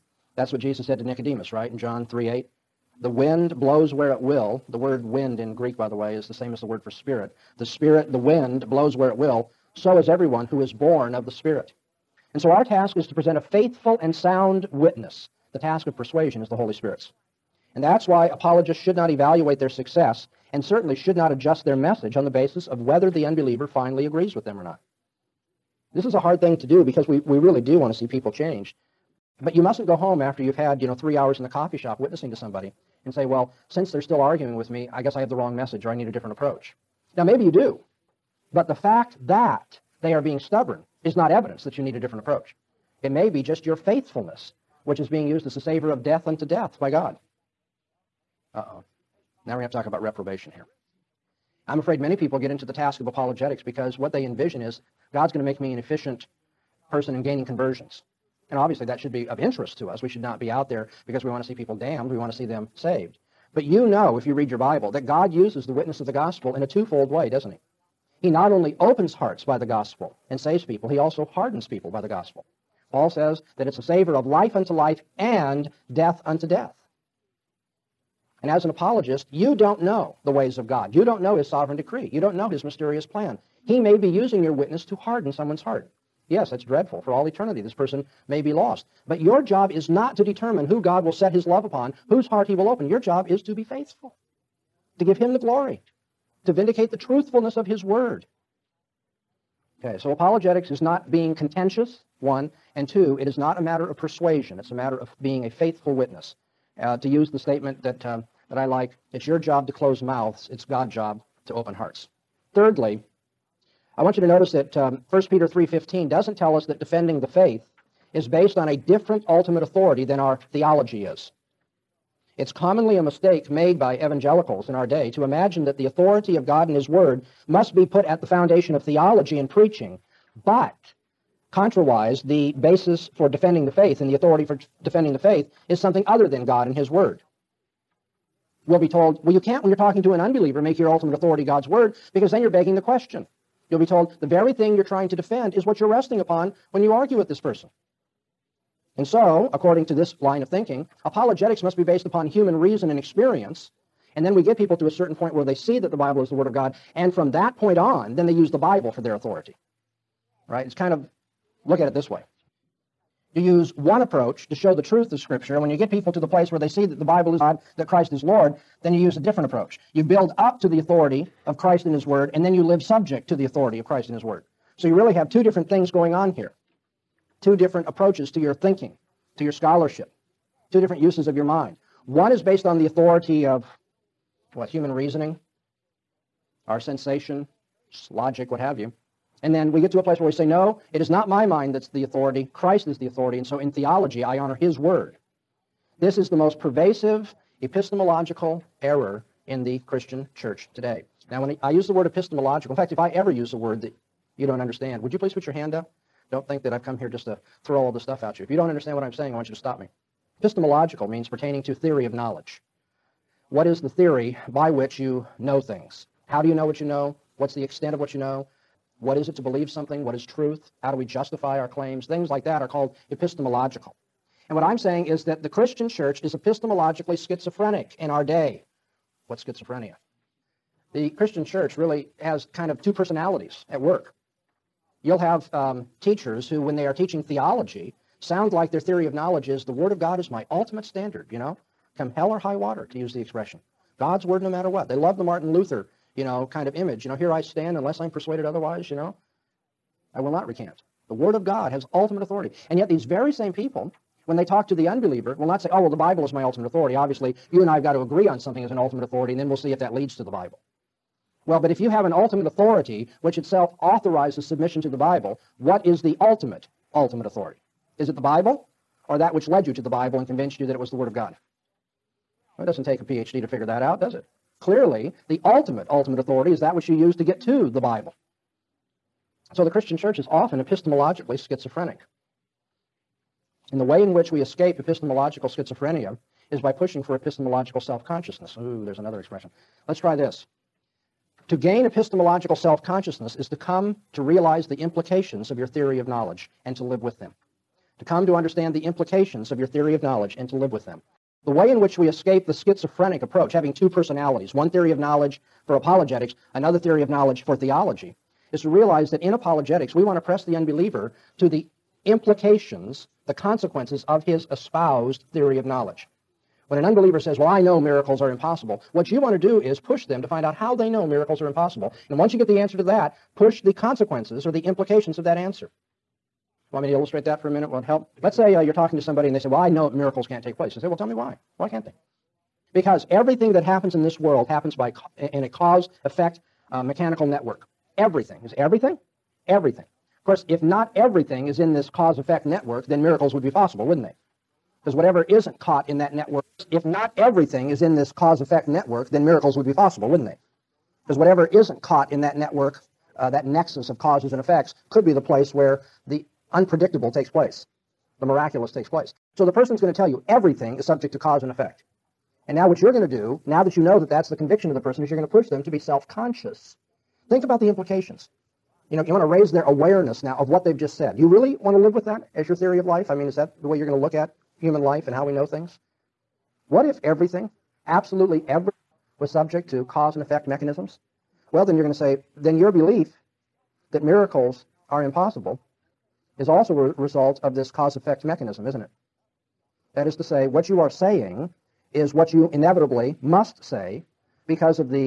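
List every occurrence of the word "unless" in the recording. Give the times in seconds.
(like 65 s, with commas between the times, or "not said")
247 s.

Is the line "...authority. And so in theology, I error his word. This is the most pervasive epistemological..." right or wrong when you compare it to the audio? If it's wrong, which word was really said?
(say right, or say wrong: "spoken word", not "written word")
wrong: "honor", not "error".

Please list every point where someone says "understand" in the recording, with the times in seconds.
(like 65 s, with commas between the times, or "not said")
204 s, 208 s, 298 s.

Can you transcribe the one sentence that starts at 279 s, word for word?
So the Christian church is often epistemologically schizophrenic.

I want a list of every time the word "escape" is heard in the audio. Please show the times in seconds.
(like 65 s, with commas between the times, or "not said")
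284 s, 302 s.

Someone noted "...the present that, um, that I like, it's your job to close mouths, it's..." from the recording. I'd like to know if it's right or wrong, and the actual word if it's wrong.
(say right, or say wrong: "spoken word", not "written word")
wrong: "statement", not "present".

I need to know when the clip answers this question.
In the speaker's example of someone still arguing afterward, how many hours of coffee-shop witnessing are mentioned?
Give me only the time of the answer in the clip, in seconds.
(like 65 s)
30 s.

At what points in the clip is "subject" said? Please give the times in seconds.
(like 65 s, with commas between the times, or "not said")
172 s, 360 s, 379 s.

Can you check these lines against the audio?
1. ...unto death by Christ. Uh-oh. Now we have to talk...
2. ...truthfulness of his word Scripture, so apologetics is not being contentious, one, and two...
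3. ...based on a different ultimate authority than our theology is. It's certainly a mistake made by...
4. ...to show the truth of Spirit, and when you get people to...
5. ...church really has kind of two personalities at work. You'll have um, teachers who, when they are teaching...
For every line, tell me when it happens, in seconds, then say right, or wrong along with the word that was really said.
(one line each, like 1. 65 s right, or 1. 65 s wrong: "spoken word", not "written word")
1. 46 s wrong: "God", not "Christ"
2. 96 s wrong: "Okay", not "Scripture"
3. 118 s wrong: "commonly", not "certainly"
4. 164 s wrong: "Scripture", not "Spirit"
5. 231 s right.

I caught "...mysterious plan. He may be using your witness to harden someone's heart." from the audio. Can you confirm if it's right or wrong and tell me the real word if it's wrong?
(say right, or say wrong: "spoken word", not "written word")
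right.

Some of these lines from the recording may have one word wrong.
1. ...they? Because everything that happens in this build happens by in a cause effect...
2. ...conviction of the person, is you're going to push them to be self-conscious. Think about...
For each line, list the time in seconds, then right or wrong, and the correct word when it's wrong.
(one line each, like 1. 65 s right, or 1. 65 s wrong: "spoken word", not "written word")
1. 331 s wrong: "world", not "build"
2. 364 s right.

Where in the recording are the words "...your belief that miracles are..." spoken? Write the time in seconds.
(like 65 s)
382 s.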